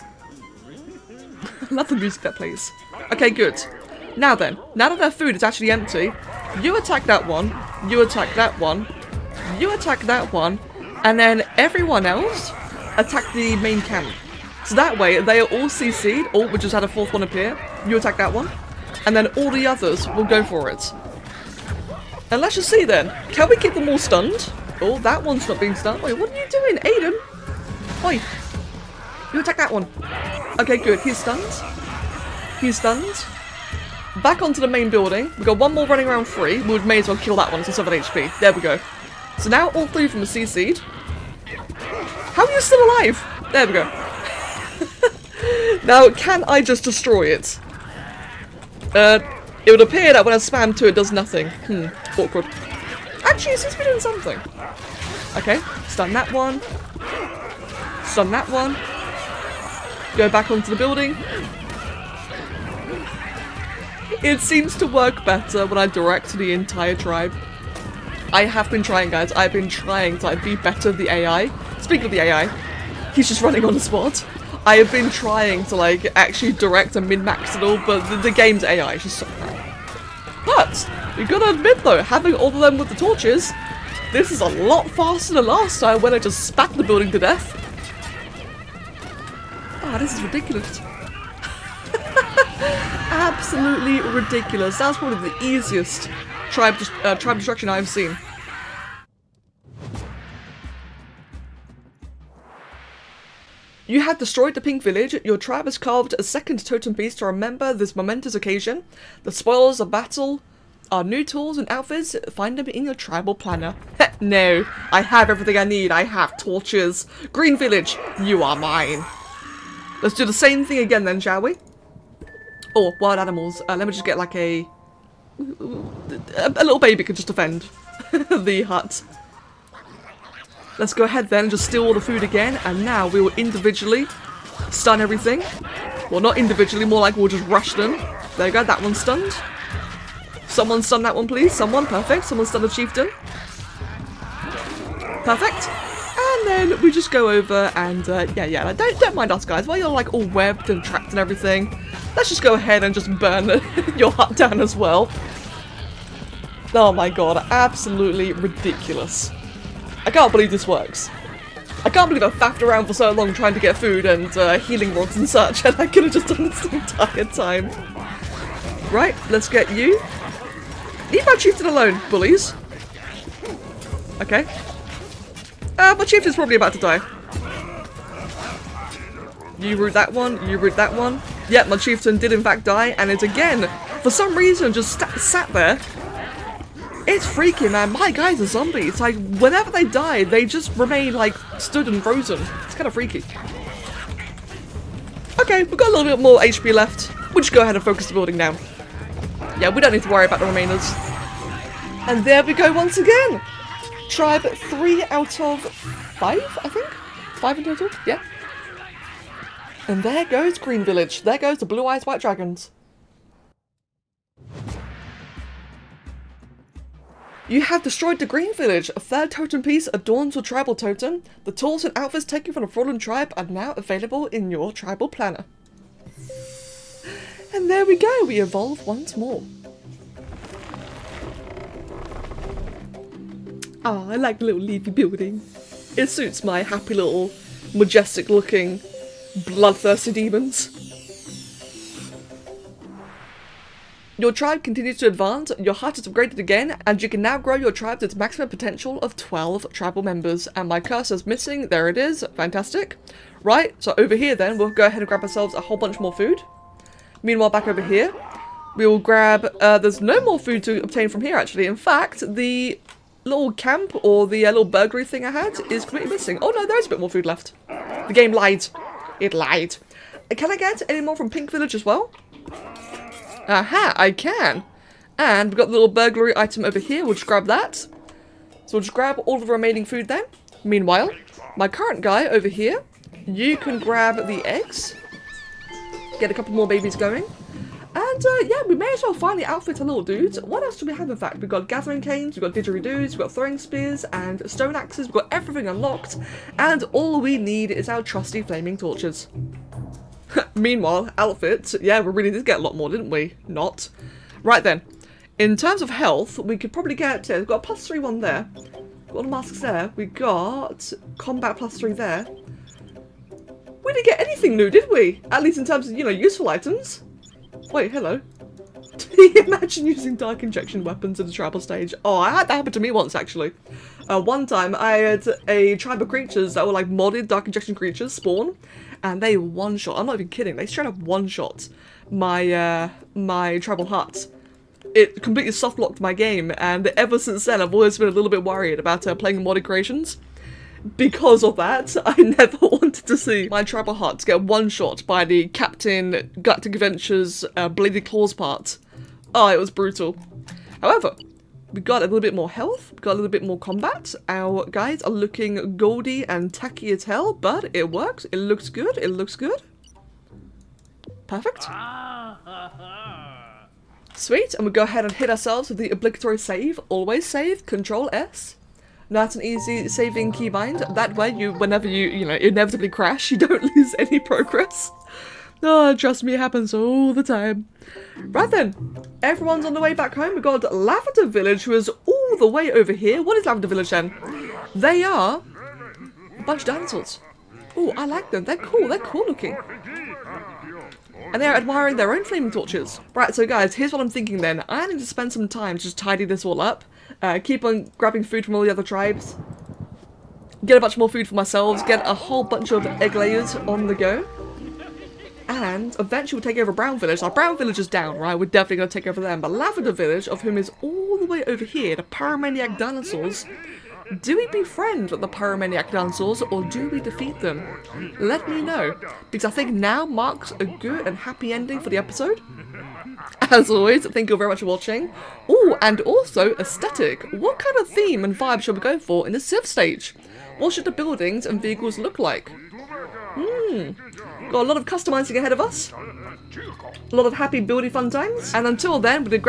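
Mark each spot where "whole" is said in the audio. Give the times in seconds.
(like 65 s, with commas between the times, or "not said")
255 s, 402 s.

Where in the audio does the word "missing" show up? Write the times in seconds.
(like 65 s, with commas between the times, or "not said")
251 s, 266 s.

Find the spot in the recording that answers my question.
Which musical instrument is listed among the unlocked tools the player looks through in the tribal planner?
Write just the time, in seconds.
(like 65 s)
292 s.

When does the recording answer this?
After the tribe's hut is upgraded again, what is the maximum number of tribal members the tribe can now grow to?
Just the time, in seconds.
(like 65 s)
249 s.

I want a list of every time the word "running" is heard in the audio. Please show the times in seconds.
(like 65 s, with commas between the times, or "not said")
35 s, 73 s.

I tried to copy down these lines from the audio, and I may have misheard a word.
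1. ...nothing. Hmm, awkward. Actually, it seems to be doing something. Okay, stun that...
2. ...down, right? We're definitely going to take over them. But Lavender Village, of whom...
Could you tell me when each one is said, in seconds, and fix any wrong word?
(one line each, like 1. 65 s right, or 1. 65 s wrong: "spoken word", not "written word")
1. 51 s right
2. 407 s right.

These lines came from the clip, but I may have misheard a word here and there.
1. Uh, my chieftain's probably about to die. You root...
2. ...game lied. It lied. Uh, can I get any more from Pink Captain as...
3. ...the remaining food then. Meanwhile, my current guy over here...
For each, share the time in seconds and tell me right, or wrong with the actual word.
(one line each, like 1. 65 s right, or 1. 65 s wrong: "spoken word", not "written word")
1. 175 s right
2. 268 s wrong: "Village", not "Captain"
3. 279 s right.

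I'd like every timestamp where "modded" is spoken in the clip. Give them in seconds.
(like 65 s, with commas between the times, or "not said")
326 s, 339 s.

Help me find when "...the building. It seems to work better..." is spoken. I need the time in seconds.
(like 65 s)
60 s.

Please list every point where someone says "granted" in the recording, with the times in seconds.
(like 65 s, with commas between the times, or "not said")
not said.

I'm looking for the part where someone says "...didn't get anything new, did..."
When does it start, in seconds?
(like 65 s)
313 s.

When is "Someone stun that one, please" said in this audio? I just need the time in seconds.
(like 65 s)
140 s.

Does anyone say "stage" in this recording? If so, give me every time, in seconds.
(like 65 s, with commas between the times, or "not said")
321 s, 429 s.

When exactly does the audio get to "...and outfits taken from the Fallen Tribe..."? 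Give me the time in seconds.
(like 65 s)
221 s.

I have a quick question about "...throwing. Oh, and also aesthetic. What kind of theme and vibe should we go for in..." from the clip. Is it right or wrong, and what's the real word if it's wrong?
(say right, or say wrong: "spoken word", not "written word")
wrong: "watching", not "throwing".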